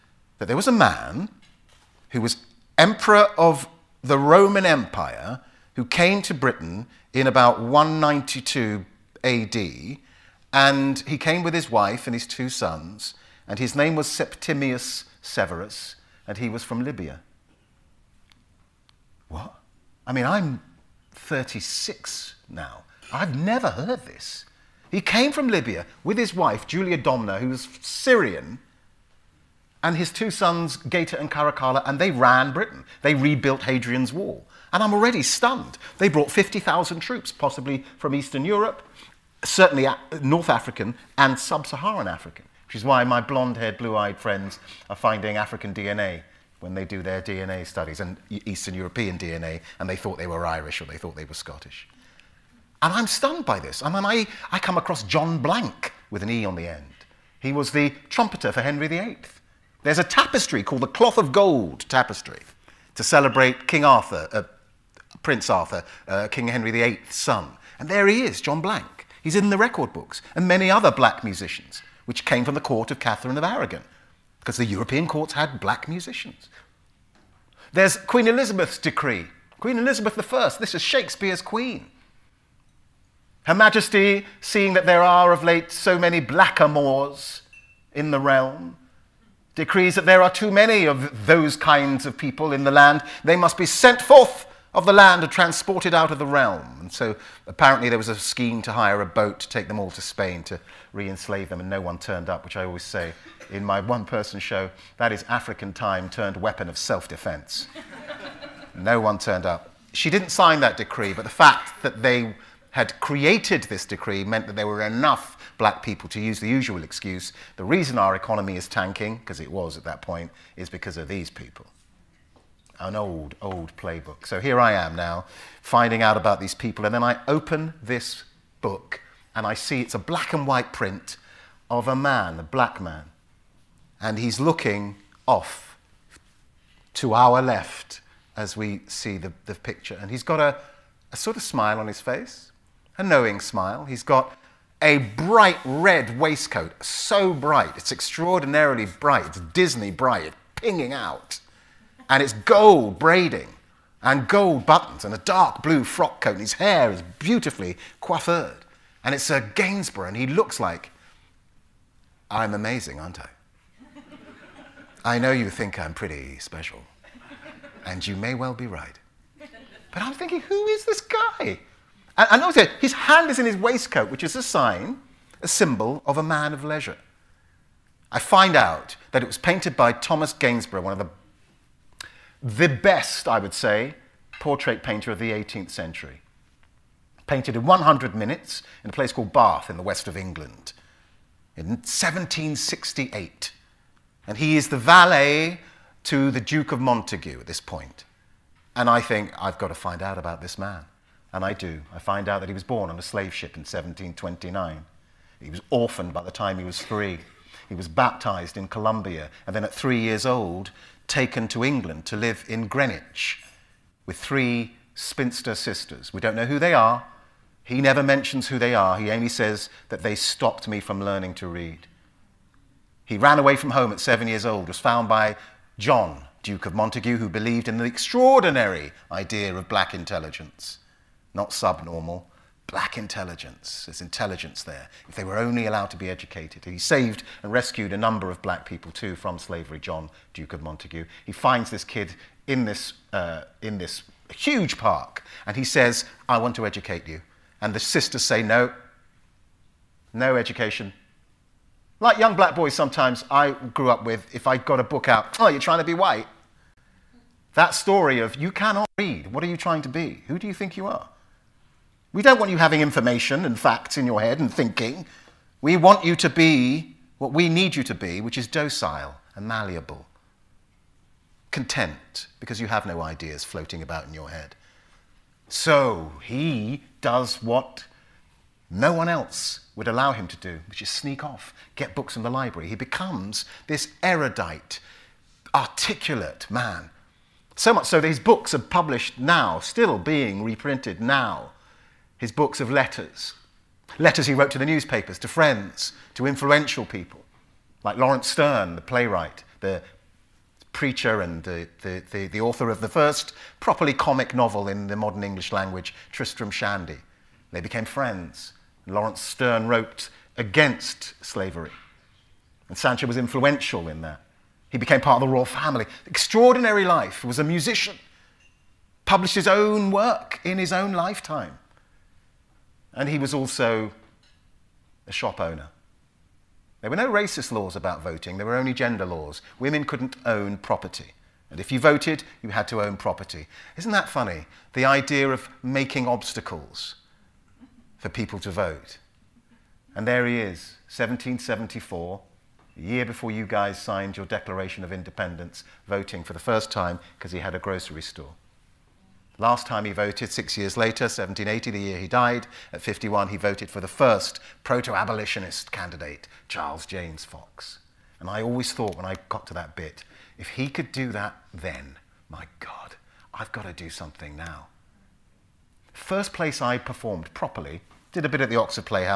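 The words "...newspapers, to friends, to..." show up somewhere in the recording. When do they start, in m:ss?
4:54.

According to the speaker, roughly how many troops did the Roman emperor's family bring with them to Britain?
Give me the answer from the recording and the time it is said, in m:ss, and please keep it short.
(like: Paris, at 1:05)
50,000, at 0:36.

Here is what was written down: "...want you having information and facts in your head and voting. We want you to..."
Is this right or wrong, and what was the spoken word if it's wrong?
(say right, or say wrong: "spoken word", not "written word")
wrong: "thinking", not "voting".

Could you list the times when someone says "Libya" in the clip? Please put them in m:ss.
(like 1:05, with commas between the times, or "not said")
0:16, 0:25.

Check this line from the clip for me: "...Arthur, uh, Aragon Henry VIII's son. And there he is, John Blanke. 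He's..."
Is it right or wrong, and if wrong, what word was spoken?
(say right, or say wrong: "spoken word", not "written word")
wrong: "King", not "Aragon".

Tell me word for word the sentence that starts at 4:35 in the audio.
So he does what no one else would allow him to do, which is sneak off, get books from the library.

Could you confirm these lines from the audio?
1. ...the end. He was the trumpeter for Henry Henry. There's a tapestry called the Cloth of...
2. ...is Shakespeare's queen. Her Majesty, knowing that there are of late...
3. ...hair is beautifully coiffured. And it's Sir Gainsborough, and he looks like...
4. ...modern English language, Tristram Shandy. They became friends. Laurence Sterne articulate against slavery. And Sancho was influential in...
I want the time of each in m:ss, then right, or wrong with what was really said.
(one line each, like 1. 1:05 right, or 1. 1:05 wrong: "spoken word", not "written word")
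1. 0:56 wrong: "VIII", not "Henry"
2. 1:20 wrong: "seeing", not "knowing"
3. 2:36 right
4. 5:04 wrong: "wrote", not "articulate".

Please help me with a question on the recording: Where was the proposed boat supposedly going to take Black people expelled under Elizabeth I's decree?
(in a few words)
Spain.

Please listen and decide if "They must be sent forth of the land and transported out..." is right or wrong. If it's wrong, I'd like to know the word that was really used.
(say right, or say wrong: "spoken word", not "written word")
right.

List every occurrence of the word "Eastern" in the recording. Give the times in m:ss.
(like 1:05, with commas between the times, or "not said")
0:38, 0:48.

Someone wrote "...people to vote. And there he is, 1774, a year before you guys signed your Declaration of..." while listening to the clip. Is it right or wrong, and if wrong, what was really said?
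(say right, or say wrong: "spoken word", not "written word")
right.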